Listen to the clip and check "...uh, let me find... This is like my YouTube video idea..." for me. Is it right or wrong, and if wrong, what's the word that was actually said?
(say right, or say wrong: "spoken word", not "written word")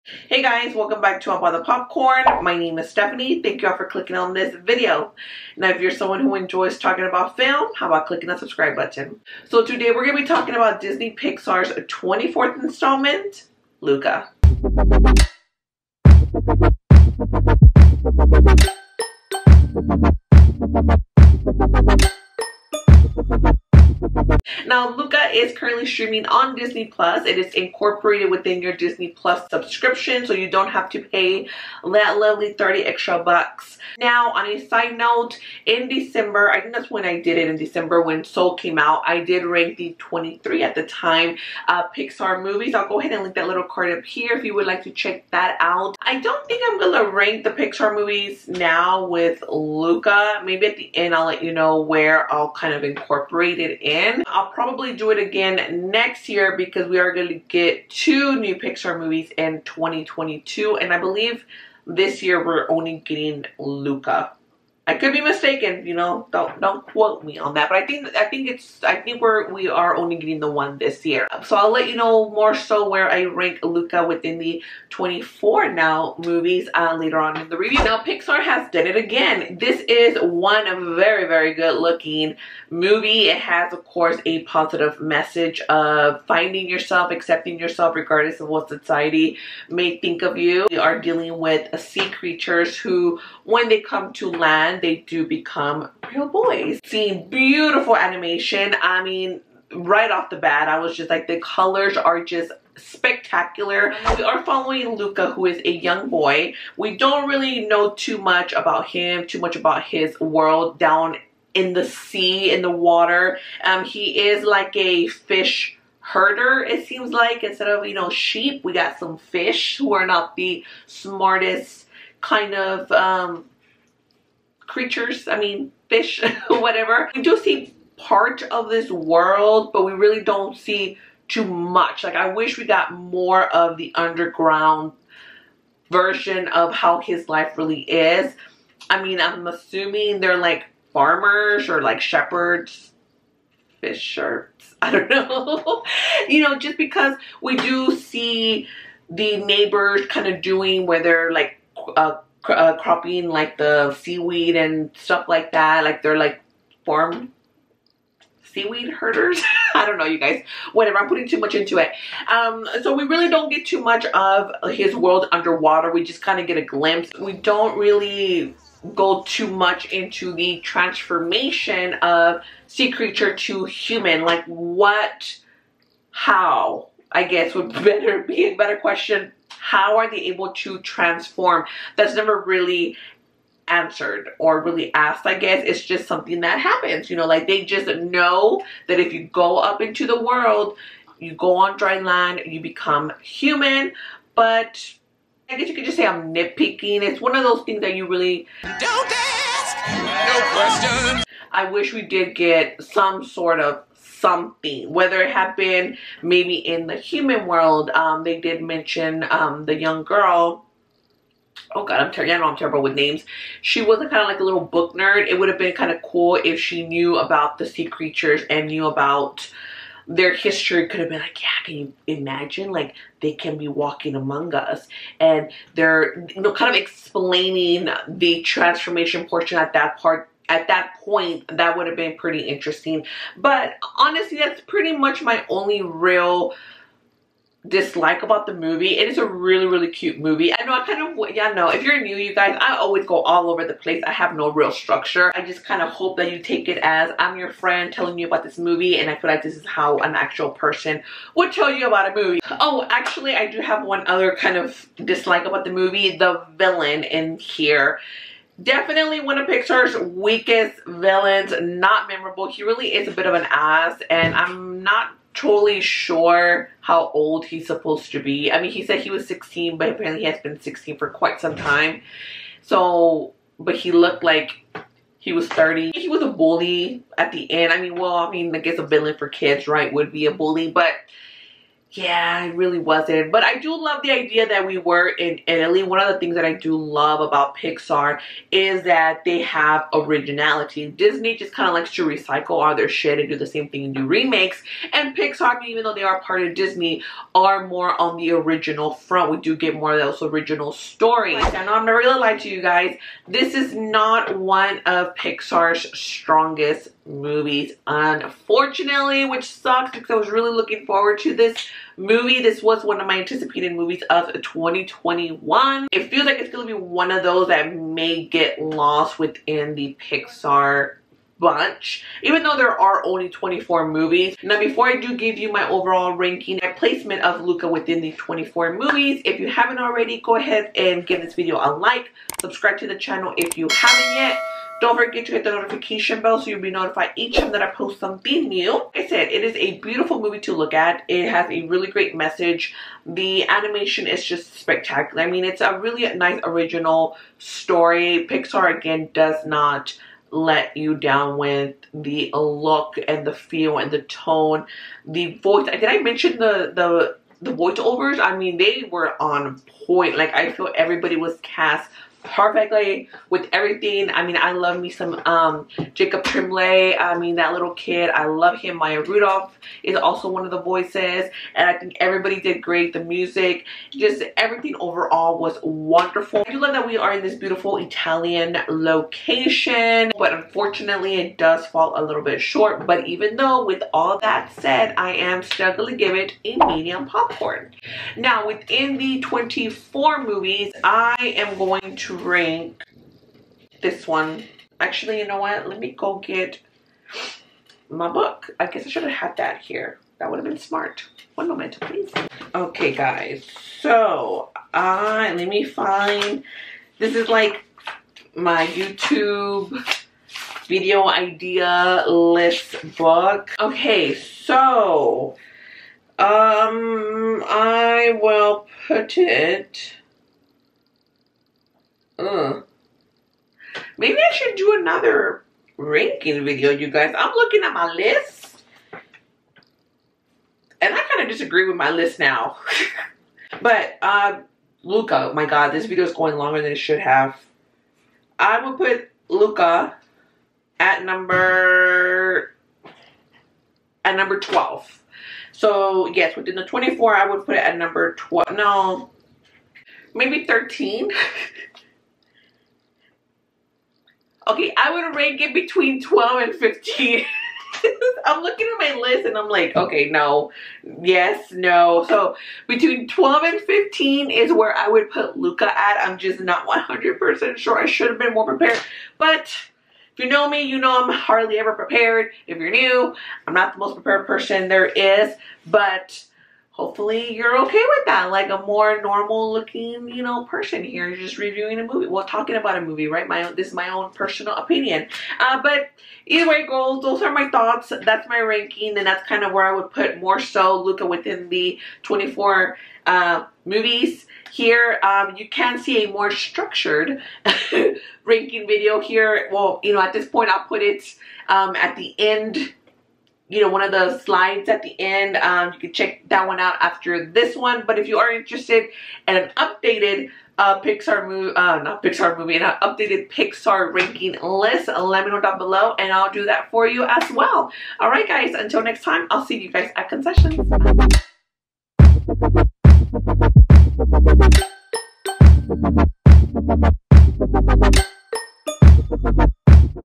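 right.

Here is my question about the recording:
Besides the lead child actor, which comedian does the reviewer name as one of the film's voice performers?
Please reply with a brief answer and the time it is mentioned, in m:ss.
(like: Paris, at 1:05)
Maya Rudolph, at 6:08.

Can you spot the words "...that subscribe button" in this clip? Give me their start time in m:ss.
0:08.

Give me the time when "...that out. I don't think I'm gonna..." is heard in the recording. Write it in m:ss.
0:45.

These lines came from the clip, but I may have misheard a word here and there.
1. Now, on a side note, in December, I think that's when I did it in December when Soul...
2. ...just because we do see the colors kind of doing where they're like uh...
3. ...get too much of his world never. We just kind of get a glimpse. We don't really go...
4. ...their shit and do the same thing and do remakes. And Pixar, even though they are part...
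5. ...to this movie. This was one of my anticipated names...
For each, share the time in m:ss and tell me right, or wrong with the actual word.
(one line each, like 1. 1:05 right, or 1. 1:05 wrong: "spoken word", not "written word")
1. 0:33 right
2. 2:26 wrong: "neighbors", not "colors"
3. 2:43 wrong: "underwater", not "never"
4. 4:52 right
5. 5:11 wrong: "movies", not "names".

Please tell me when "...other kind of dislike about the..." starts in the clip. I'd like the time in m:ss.
4:14.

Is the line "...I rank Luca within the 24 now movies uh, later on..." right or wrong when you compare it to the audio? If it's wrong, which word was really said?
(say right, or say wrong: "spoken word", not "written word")
right.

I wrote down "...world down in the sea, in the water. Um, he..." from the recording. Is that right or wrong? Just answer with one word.
right.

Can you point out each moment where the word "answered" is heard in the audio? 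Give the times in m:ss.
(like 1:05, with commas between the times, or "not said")
3:03.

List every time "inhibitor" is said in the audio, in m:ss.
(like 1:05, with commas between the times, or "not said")
not said.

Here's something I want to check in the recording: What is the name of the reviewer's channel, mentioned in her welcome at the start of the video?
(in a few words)
I'll Buy the Popcorn.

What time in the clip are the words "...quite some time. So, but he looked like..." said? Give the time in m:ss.
4:31.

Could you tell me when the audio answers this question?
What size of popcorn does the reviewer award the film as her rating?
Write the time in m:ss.
6:26.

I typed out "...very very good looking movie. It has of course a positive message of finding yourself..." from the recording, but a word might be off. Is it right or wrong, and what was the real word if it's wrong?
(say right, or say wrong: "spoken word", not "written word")
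right.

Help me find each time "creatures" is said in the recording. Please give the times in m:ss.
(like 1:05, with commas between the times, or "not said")
1:32, 2:04, 2:52, 3:37.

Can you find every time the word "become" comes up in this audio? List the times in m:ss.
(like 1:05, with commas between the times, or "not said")
1:35, 3:12.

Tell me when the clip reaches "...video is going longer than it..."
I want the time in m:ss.
7:15.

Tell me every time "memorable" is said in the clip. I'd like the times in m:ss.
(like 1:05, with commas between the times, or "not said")
4:22.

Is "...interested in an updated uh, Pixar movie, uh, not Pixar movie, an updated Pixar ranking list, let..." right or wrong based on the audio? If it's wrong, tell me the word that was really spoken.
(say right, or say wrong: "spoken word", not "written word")
right.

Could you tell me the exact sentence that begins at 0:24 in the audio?
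Now, Luca is currently streaming on Disney Plus.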